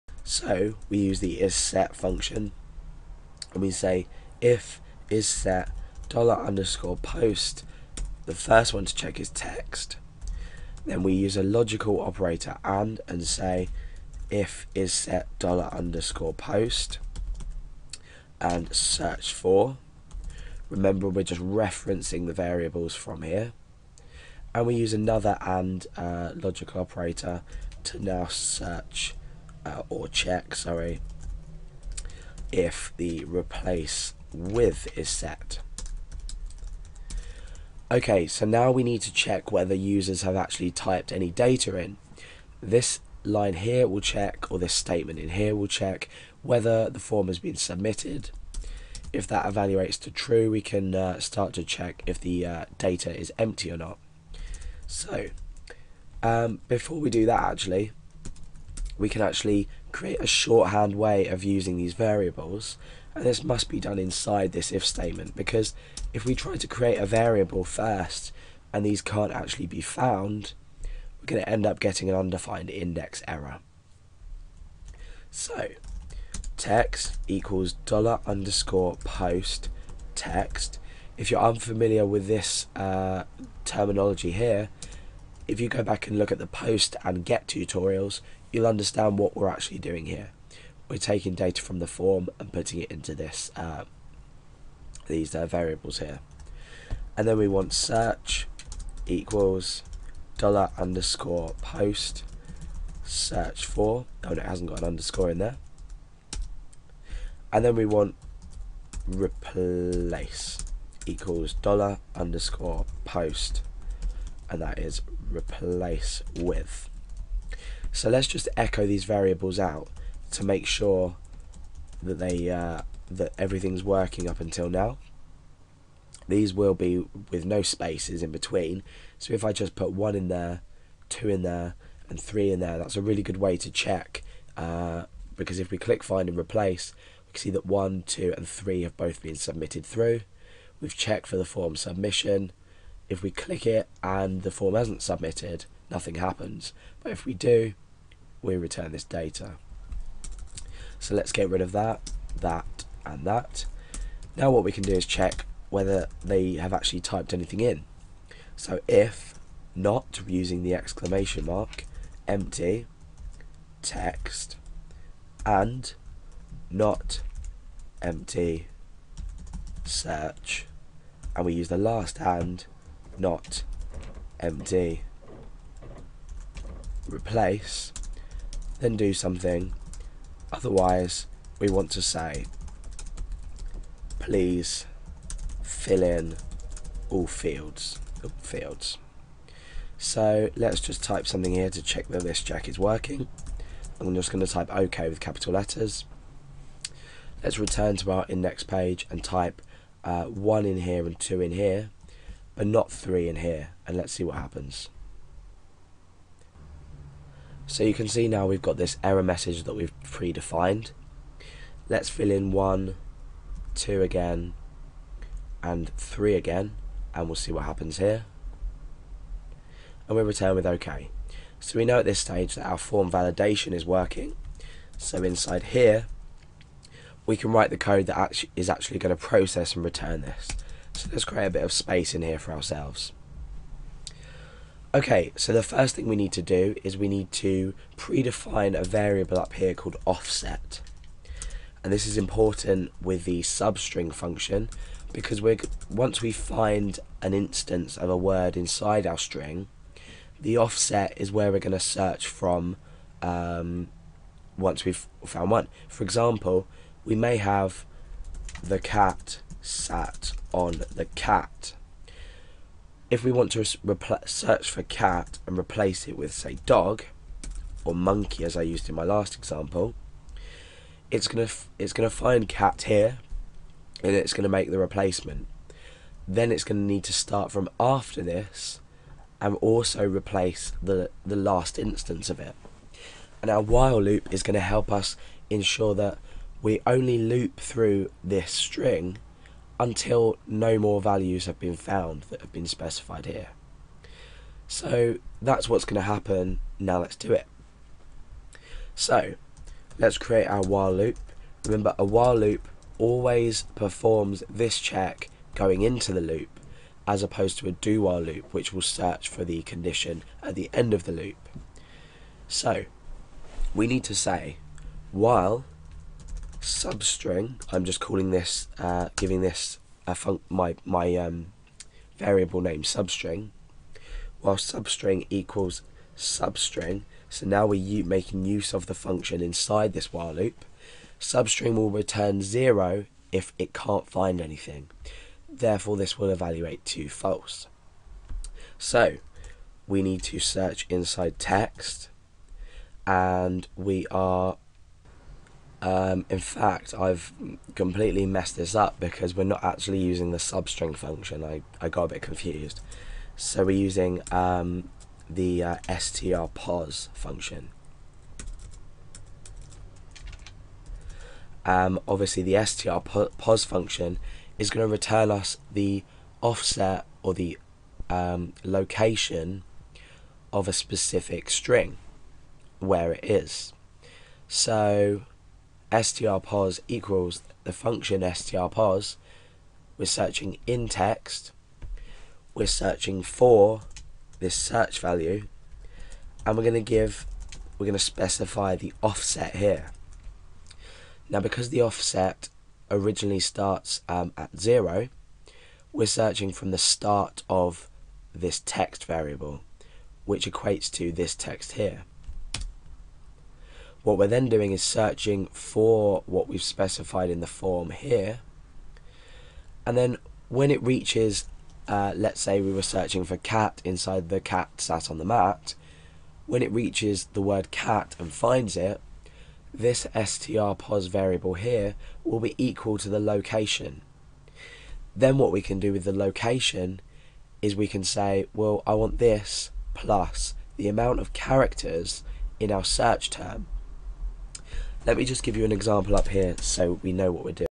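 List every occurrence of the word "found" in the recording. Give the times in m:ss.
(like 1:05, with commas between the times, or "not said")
1:09, 4:15, 4:51.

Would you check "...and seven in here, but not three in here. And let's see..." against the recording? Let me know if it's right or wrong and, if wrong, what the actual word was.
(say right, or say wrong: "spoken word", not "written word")
wrong: "two", not "seven".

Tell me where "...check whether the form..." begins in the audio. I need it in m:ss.
0:45.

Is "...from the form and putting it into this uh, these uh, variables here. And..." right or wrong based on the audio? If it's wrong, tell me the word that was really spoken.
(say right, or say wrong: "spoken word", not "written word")
right.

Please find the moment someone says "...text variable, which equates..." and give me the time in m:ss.
6:38.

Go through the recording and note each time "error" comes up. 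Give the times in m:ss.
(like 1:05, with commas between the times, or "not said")
1:13, 3:29.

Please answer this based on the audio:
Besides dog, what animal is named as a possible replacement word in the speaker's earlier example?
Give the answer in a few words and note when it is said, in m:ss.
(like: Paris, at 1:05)
monkey, at 4:27.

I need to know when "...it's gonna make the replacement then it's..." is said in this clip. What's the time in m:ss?
4:34.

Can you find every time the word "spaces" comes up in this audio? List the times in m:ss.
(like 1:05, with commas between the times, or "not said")
2:07, 3:51.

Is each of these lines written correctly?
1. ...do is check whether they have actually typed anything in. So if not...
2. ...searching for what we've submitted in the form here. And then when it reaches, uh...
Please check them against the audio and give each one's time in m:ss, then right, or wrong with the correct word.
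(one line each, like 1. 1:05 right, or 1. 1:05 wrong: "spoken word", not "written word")
1. 2:34 right
2. 6:44 wrong: "specified", not "submitted".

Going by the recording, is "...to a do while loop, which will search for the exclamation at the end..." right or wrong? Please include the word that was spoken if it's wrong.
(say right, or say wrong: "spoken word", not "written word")
wrong: "condition", not "exclamation".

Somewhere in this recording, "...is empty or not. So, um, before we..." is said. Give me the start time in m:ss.
0:53.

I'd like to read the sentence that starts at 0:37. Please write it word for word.
Okay, so now we need to check whether users have actually typed any data in.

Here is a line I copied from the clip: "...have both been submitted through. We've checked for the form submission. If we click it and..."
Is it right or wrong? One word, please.
right.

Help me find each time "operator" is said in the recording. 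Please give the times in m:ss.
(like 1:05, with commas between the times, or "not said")
0:11, 0:26.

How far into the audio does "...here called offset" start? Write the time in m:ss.
3:59.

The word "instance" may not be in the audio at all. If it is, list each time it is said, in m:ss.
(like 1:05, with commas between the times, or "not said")
4:07, 4:41.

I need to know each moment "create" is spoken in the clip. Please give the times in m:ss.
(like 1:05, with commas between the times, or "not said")
0:59, 1:06, 3:51, 5:00.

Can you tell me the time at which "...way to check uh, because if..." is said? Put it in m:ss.
2:13.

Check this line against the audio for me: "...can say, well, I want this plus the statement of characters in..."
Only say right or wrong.
wrong.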